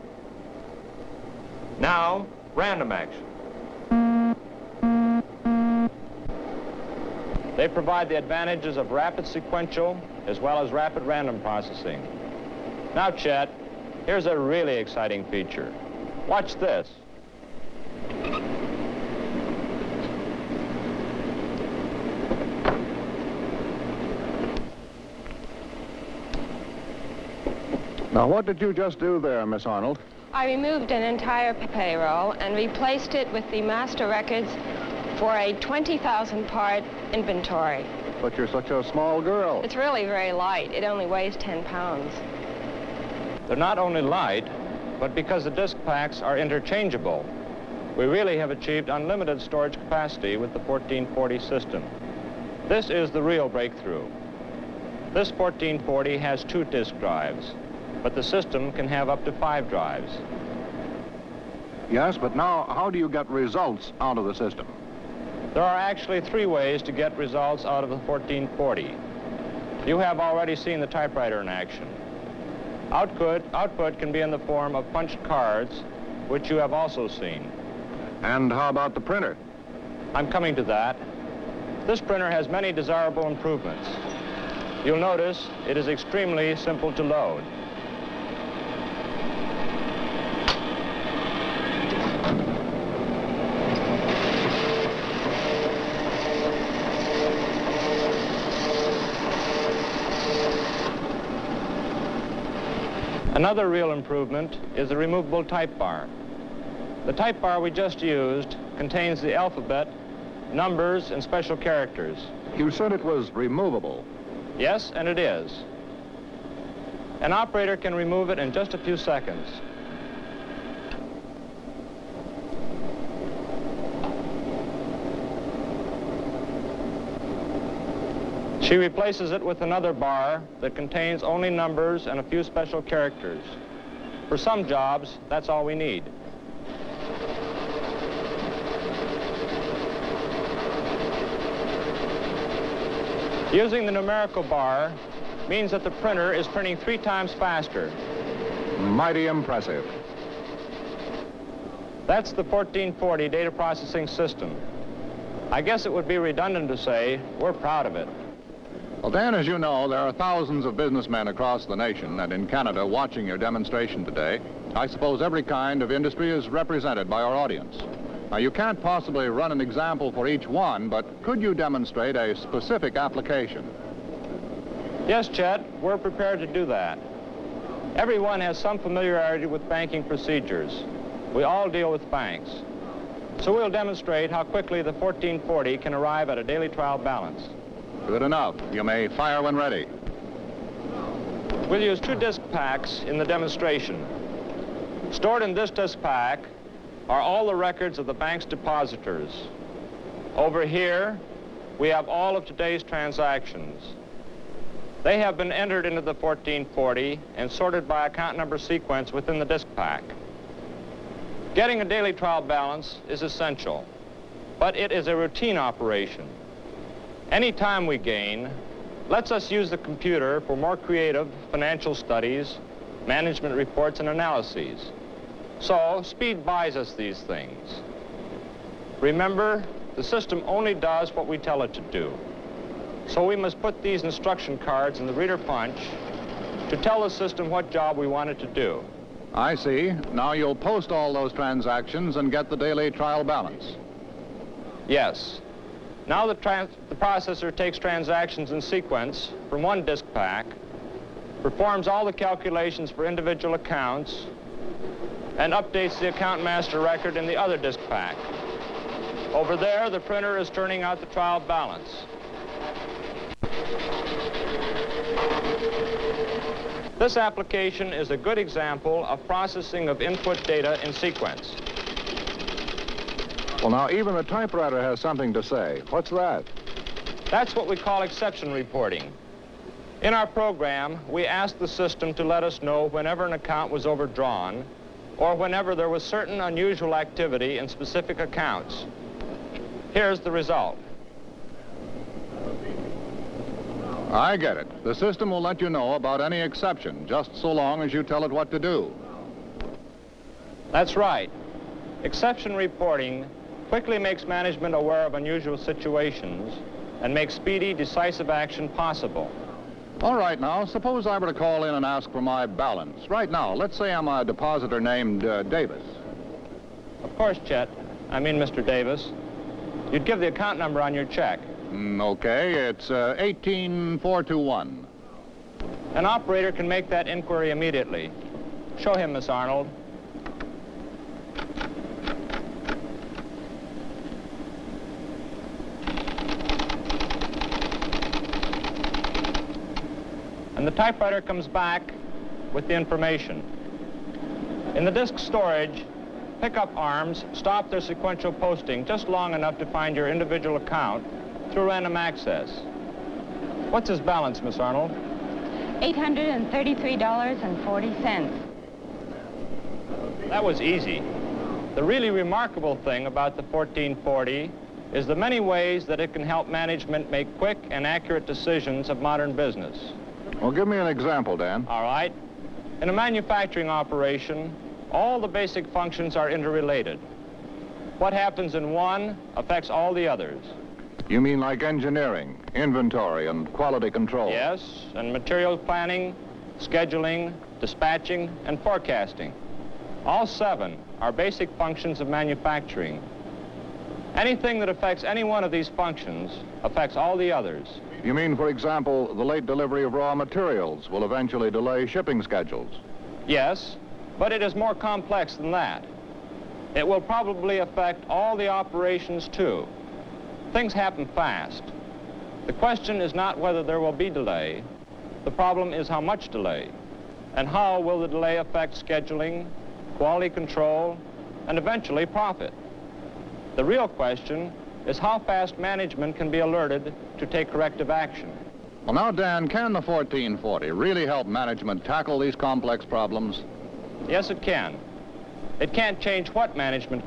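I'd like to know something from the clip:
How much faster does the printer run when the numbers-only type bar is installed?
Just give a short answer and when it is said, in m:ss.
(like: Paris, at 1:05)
3 times, at 2:26.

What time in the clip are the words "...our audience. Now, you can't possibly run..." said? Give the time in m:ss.
2:47.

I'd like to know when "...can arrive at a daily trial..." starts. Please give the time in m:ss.
3:05.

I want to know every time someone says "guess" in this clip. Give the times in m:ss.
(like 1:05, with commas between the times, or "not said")
2:35.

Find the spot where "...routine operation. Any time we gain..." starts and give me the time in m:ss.
3:35.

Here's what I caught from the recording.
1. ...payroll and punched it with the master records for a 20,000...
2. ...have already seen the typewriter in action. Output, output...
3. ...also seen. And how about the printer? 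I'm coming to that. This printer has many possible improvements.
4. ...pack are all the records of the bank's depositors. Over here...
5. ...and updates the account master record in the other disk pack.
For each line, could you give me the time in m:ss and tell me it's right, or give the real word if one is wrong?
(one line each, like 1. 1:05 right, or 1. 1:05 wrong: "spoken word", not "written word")
1. 0:31 wrong: "replaced", not "punched"
2. 1:09 right
3. 1:16 wrong: "desirable", not "possible"
4. 3:16 right
5. 4:15 right.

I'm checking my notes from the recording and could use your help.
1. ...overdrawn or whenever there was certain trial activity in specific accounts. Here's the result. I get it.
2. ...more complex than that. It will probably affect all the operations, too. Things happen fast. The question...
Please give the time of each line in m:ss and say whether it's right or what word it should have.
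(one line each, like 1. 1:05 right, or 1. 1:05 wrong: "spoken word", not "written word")
1. 4:43 wrong: "unusual", not "trial"
2. 6:44 right.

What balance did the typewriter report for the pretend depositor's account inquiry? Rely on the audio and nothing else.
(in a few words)
$833.40.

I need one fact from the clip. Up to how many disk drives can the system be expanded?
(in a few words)
5.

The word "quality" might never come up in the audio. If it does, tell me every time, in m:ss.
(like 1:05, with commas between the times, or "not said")
6:23, 6:59.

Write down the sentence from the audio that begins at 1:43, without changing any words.
Another real improvement is the removable type bar.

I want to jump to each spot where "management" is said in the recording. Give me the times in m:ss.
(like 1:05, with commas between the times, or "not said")
3:43, 5:04, 6:06, 7:05, 7:11, 7:16.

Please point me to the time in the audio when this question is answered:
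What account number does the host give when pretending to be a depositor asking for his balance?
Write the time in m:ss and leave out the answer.
5:23.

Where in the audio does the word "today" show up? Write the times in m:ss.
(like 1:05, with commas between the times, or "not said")
2:44, 3:22.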